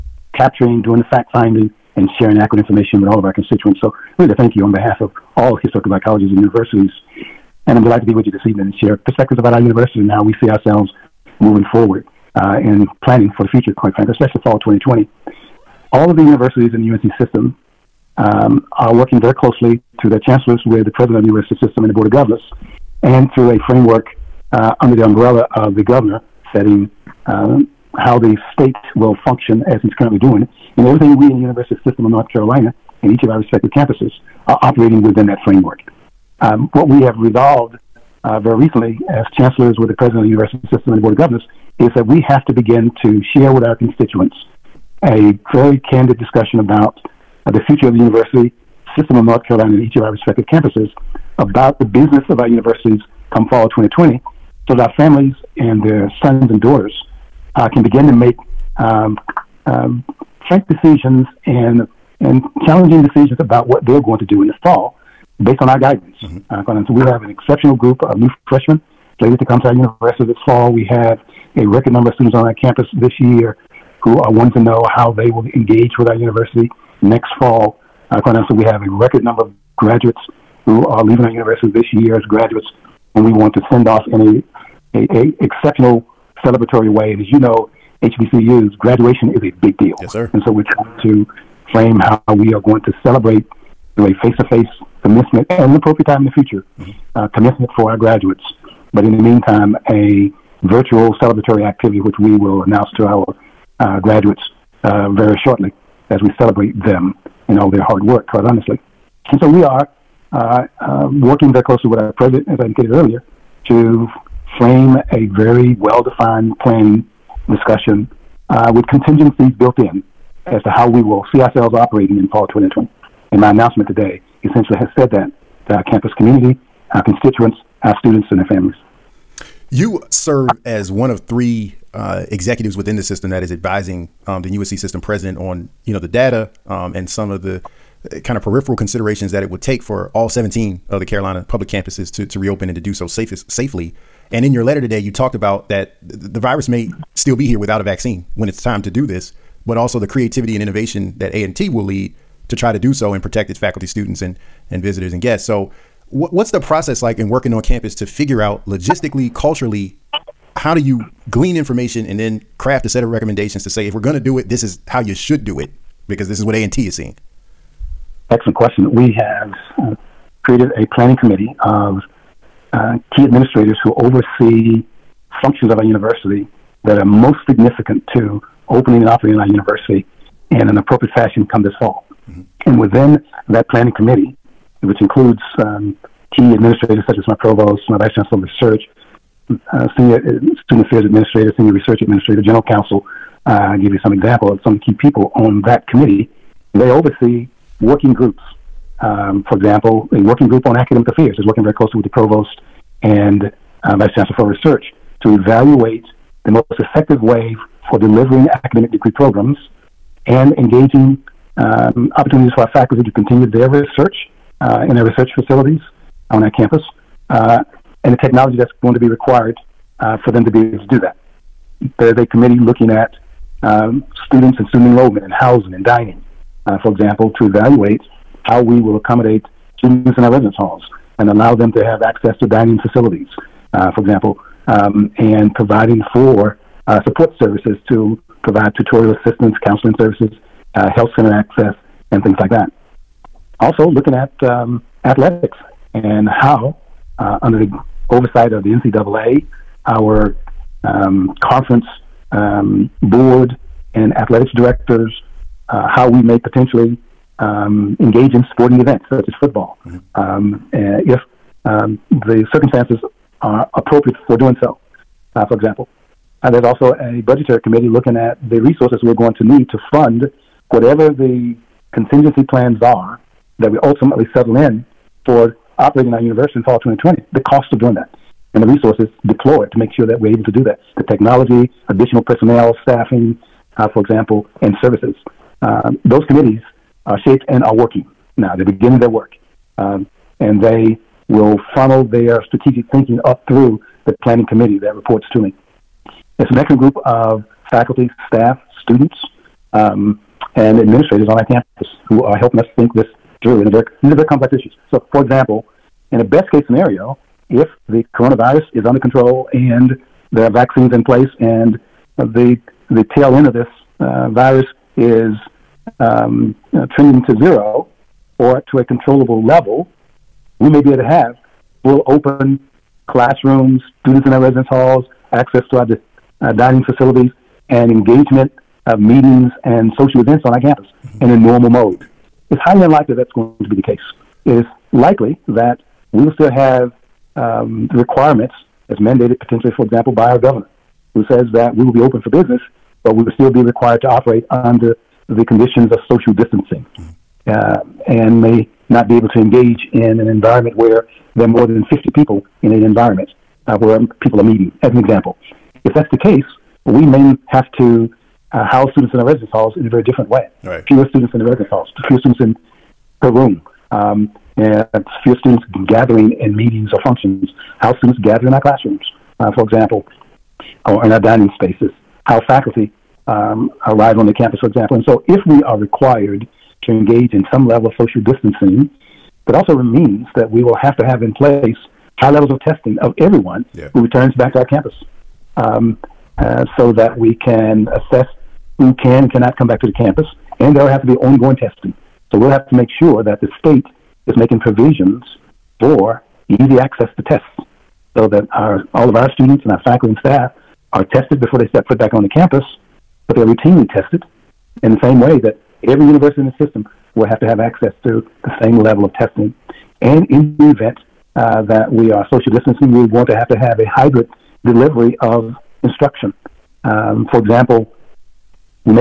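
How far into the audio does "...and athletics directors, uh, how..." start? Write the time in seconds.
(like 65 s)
253 s.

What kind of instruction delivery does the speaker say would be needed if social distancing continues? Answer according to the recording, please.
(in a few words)
Hybrid.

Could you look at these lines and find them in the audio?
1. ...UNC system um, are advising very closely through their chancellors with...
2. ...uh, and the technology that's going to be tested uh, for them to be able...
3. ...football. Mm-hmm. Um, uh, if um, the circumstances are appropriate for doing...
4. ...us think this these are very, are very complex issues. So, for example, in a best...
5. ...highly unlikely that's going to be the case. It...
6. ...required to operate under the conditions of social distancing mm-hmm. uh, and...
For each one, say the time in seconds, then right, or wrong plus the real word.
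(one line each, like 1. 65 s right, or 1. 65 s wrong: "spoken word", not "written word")
1. 16 s wrong: "working", not "advising"
2. 217 s wrong: "required", not "tested"
3. 259 s right
4. 302 s right
5. 332 s right
6. 343 s right.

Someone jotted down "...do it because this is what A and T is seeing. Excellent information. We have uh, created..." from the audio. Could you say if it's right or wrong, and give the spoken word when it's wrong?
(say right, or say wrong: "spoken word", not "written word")
wrong: "question", not "information".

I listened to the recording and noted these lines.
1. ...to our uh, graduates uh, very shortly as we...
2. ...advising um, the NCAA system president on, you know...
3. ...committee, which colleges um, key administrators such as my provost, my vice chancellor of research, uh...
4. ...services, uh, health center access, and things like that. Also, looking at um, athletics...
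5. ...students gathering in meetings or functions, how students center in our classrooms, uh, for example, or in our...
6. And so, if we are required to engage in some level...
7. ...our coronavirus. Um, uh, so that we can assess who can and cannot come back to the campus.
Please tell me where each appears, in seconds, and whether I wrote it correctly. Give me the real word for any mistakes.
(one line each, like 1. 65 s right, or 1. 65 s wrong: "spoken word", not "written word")
1. 102 s right
2. 133 s wrong: "UNC", not "NCAA"
3. 183 s wrong: "includes", not "colleges"
4. 239 s right
5. 365 s wrong: "gather", not "center"
6. 374 s right
7. 384 s wrong: "campus", not "coronavirus".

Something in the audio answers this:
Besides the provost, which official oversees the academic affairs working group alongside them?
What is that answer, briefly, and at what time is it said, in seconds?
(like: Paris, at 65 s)
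Vice chancellor for research, at 203 s.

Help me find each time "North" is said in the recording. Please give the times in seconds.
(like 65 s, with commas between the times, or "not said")
32 s, 49 s.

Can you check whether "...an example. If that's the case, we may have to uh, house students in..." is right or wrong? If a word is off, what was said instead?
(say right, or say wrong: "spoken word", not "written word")
right.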